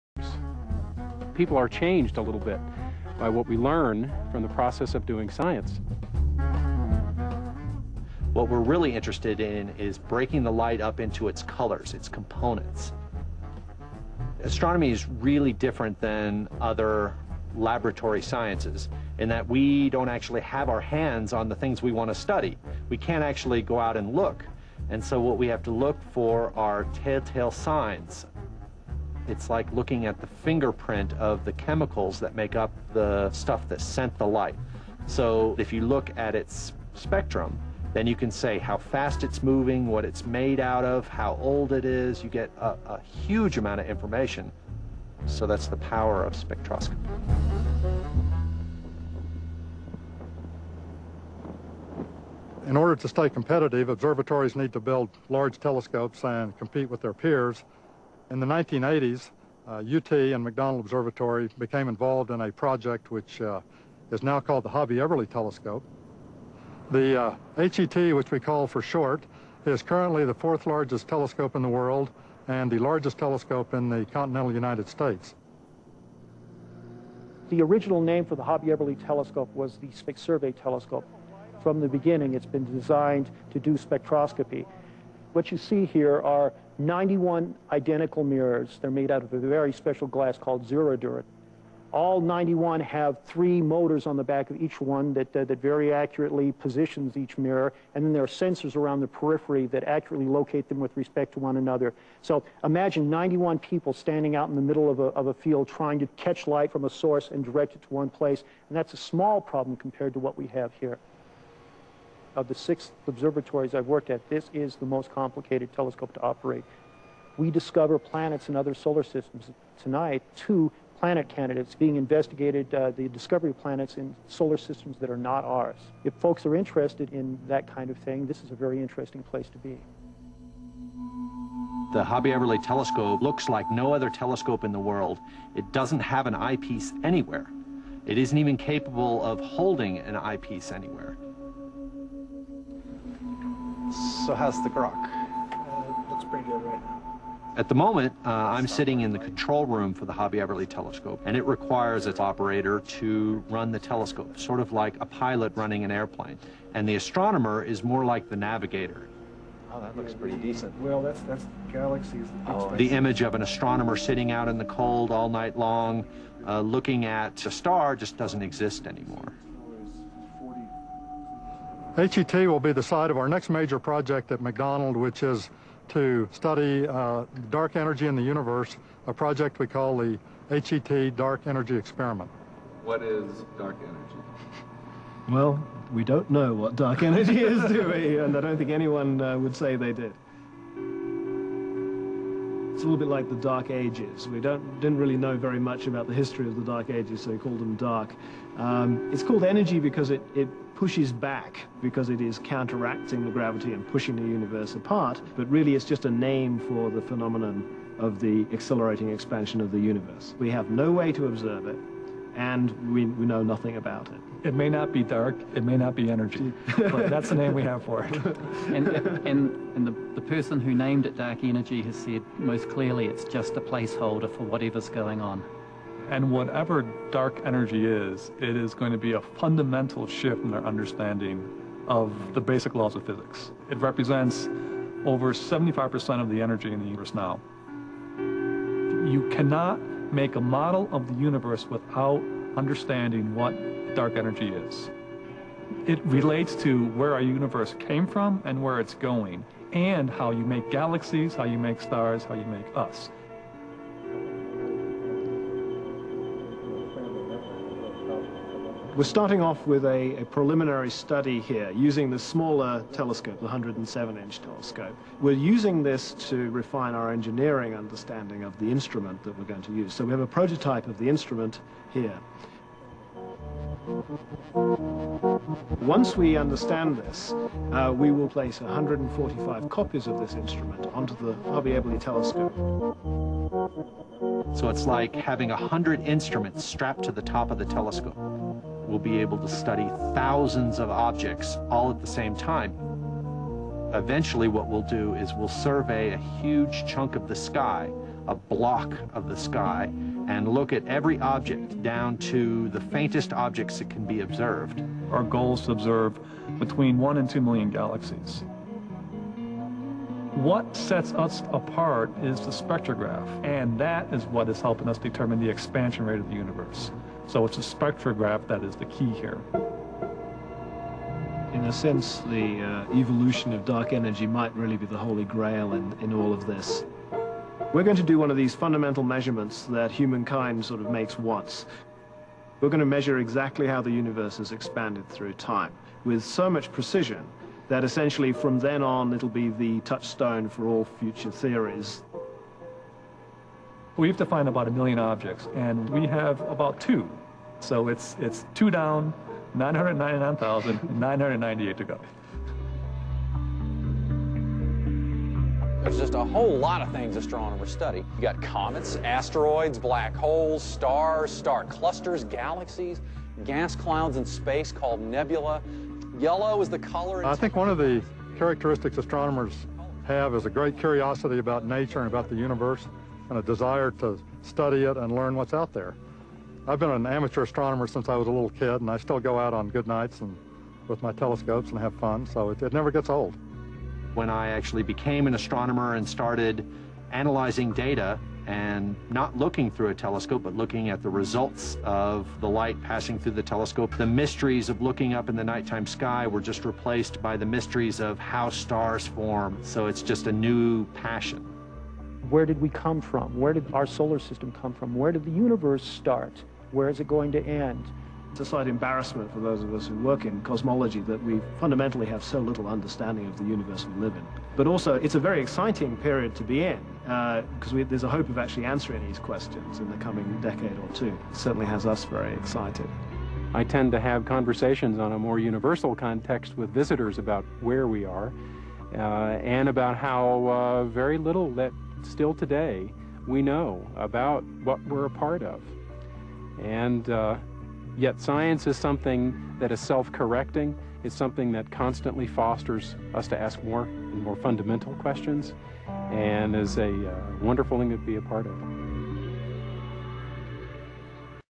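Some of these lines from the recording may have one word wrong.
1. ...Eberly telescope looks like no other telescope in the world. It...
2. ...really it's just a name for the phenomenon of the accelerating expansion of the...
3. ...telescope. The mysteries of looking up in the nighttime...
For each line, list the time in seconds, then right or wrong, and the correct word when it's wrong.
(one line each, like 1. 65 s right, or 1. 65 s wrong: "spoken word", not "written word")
1. 132 s right
2. 205 s right
3. 393 s right.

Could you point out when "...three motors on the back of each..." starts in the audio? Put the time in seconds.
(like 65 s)
93 s.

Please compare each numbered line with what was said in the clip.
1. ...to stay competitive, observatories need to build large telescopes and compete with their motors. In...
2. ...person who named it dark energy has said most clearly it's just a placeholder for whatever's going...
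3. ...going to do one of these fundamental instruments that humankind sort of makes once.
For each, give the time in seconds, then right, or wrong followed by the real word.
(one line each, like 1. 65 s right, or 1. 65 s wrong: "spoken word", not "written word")
1. 52 s wrong: "peers", not "motors"
2. 220 s right
3. 327 s wrong: "measurements", not "instruments".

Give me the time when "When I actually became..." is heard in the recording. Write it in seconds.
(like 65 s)
384 s.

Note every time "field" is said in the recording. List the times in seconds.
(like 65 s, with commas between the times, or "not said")
105 s.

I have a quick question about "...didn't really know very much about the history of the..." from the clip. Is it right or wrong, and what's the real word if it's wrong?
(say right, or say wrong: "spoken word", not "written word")
right.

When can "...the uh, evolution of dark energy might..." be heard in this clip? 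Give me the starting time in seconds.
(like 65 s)
322 s.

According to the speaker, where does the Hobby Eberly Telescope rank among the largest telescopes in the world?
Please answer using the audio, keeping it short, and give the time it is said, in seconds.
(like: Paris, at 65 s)
fourth largest, at 70 s.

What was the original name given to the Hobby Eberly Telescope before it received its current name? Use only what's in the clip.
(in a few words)
Space Survey Telescope.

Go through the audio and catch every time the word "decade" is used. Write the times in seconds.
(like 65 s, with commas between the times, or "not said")
420 s.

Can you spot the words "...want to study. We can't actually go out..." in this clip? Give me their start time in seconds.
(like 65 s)
21 s.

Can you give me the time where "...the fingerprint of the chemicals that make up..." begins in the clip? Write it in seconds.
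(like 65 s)
30 s.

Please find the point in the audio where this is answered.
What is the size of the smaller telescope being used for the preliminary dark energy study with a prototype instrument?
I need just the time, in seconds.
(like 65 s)
263 s.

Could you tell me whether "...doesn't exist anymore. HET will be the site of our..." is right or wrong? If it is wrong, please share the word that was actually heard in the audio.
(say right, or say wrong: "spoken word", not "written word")
right.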